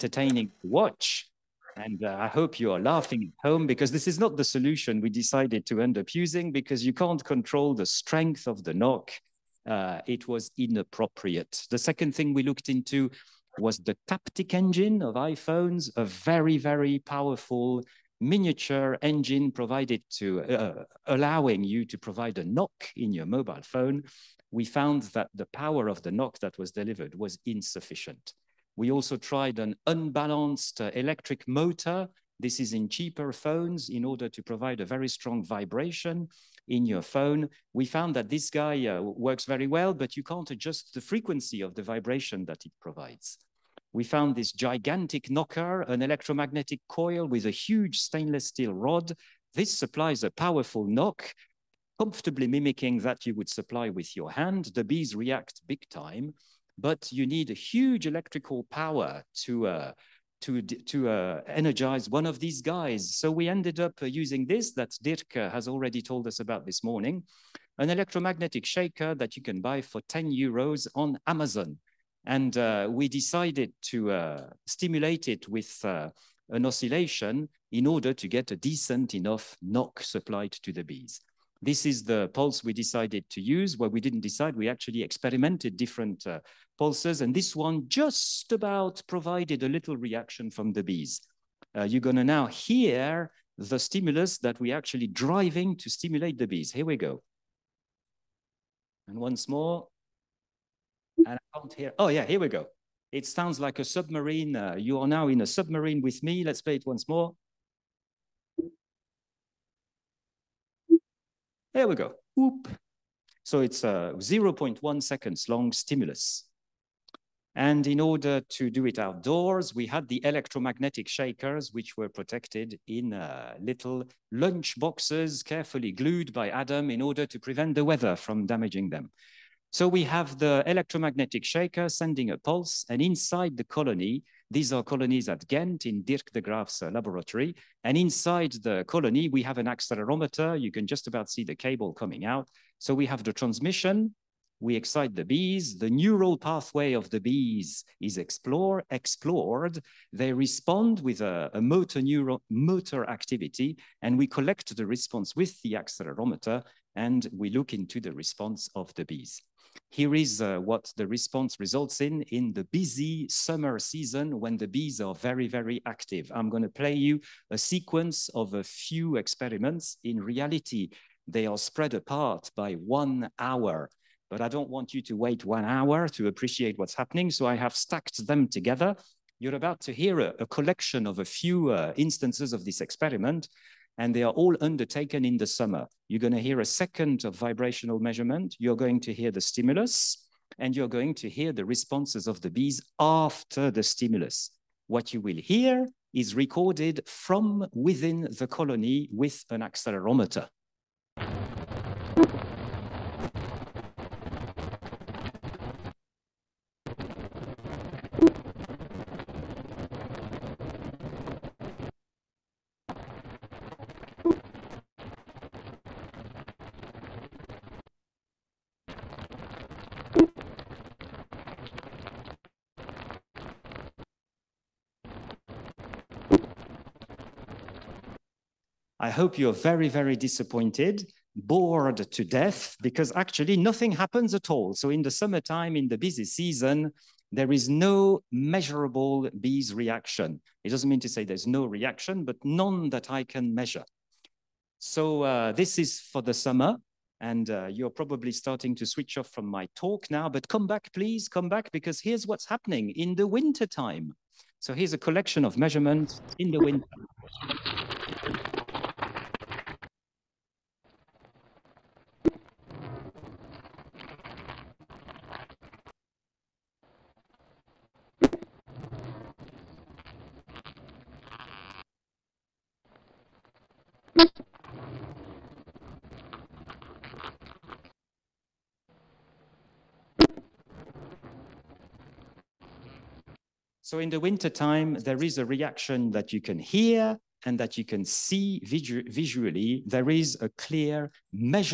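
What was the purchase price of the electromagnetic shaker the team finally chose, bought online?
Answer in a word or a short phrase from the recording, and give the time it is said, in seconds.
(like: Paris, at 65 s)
10 euros, at 70 s.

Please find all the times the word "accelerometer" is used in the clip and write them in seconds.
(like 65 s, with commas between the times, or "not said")
139 s, 155 s, 199 s.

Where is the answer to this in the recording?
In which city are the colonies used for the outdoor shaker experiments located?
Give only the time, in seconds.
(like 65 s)
135 s.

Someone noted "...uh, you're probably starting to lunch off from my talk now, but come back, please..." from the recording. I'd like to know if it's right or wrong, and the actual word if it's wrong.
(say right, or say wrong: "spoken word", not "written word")
wrong: "switch", not "lunch".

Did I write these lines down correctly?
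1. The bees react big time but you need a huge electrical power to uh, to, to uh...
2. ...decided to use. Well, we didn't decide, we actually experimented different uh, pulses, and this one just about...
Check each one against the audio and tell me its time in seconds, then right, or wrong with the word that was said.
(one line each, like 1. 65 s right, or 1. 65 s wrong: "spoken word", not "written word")
1. 54 s right
2. 82 s right.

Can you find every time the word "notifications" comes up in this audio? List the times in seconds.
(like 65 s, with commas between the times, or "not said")
not said.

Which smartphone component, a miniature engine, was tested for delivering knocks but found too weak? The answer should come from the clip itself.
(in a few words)
Taptic engine.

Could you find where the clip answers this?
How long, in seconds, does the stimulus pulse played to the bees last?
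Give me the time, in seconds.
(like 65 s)
114 s.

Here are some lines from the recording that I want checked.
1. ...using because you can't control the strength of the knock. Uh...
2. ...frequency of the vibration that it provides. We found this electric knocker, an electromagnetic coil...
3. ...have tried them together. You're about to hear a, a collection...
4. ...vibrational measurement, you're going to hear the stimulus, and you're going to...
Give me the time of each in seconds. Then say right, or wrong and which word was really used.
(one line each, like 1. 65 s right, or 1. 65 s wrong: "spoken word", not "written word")
1. 6 s right
2. 41 s wrong: "gigantic", not "electric"
3. 177 s wrong: "stacked", not "tried"
4. 187 s right.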